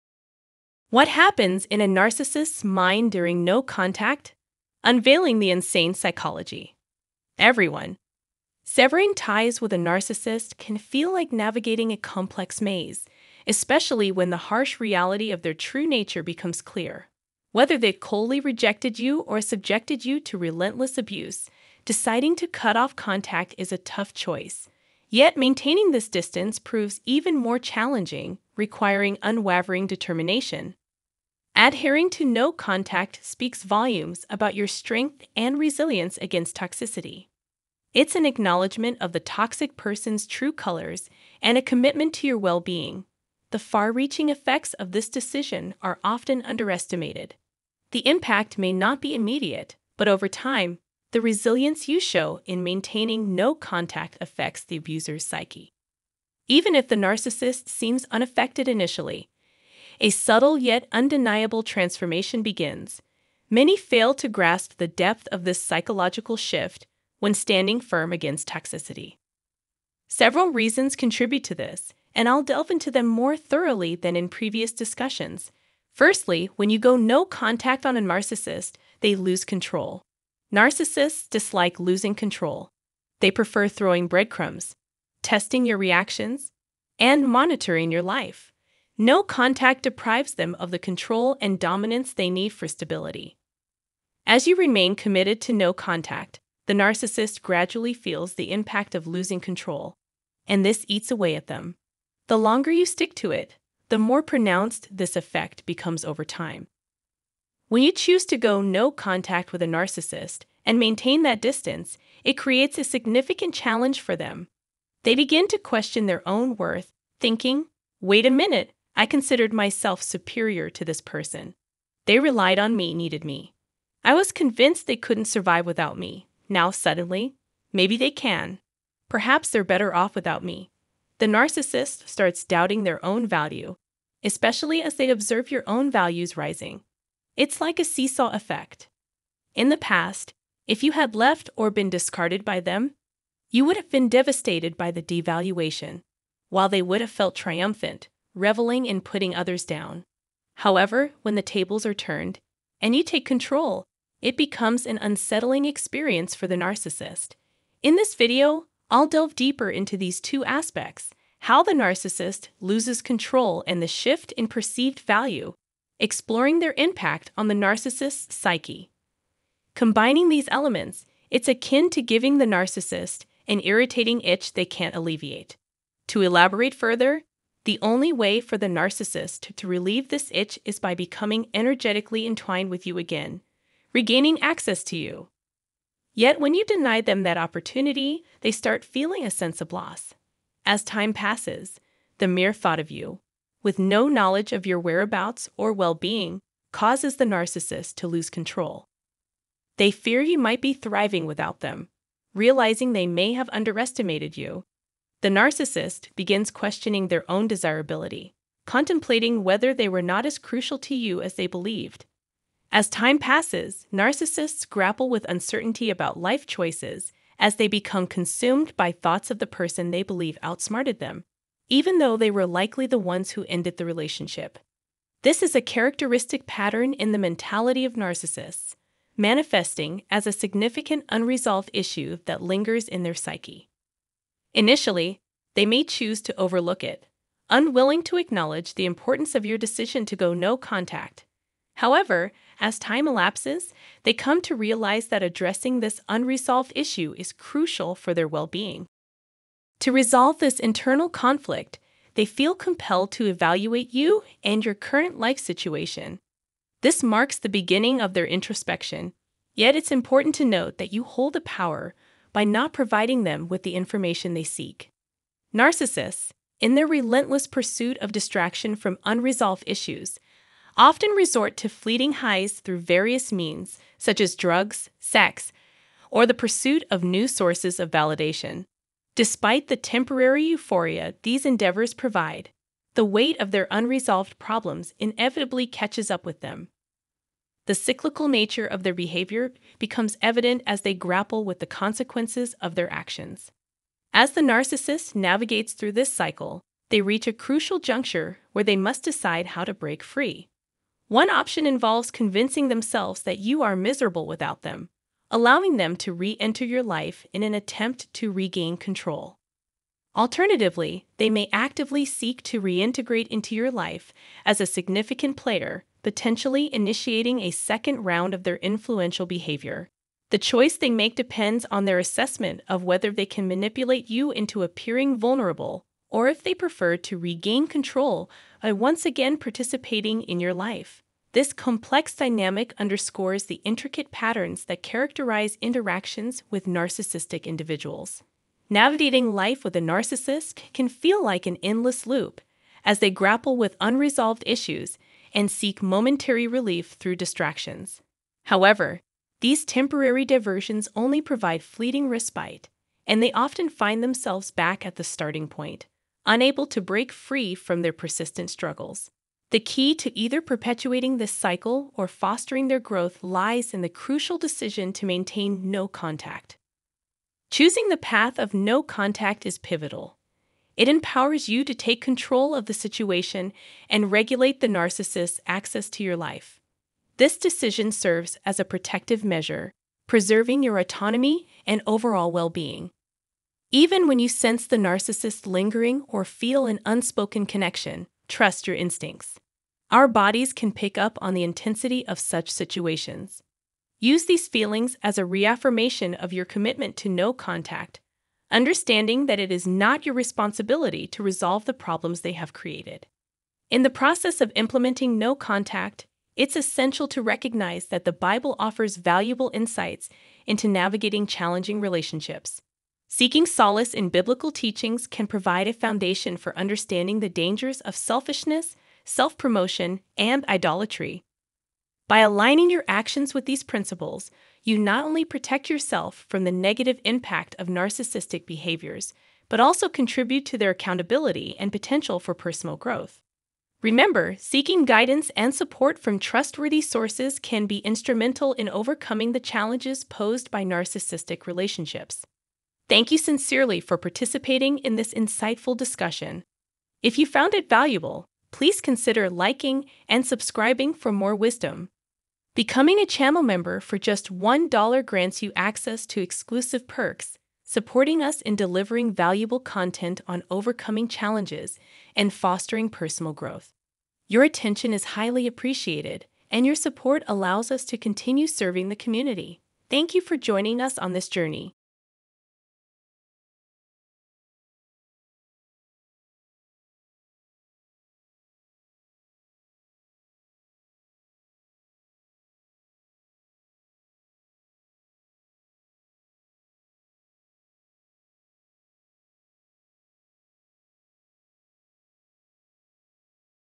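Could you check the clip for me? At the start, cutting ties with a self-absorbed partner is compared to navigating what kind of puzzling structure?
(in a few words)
A complex maze.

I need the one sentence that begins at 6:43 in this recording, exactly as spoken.
In the process of implementing no contact, it's essential to recognize that the Bible offers valuable insights into navigating challenging relationships.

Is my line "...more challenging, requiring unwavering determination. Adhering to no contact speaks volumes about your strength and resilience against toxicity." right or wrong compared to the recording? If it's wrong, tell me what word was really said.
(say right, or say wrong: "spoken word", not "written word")
right.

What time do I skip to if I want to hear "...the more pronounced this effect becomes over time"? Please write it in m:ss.
1:43.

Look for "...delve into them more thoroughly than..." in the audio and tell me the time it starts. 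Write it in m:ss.
1:12.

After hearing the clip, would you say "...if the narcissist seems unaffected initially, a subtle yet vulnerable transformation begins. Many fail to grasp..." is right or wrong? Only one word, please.
wrong.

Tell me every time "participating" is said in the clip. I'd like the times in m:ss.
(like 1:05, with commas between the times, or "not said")
5:29, 7:23.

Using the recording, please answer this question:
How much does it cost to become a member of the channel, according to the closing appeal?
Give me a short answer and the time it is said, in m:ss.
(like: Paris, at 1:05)
$1, at 7:34.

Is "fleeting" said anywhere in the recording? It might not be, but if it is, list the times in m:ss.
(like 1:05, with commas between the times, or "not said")
4:31, 5:51.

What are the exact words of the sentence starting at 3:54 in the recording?
Initially, they may choose to overlook it, unwilling to acknowledge the importance of your decision to go no contact.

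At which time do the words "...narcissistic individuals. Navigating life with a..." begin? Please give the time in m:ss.
5:36.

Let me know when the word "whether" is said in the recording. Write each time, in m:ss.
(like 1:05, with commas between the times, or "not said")
0:17, 3:29, 5:22.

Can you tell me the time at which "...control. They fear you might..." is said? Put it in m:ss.
3:18.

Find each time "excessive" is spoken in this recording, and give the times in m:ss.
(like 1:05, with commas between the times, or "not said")
not said.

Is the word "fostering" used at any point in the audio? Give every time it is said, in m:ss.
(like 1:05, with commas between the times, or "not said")
6:02, 7:42.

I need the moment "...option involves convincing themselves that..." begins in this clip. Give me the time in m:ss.
5:01.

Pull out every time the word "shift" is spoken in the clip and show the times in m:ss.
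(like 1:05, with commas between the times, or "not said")
1:06, 2:43.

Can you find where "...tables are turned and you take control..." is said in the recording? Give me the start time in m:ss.
2:31.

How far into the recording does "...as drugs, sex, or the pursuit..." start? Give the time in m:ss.
4:34.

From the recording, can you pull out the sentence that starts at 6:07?
Choosing the path of no contact is pivotal.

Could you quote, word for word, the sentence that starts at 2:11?
The narcissist starts doubting their own value, especially as they observe your own values rising.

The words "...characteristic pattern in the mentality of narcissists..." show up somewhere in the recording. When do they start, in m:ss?
3:45.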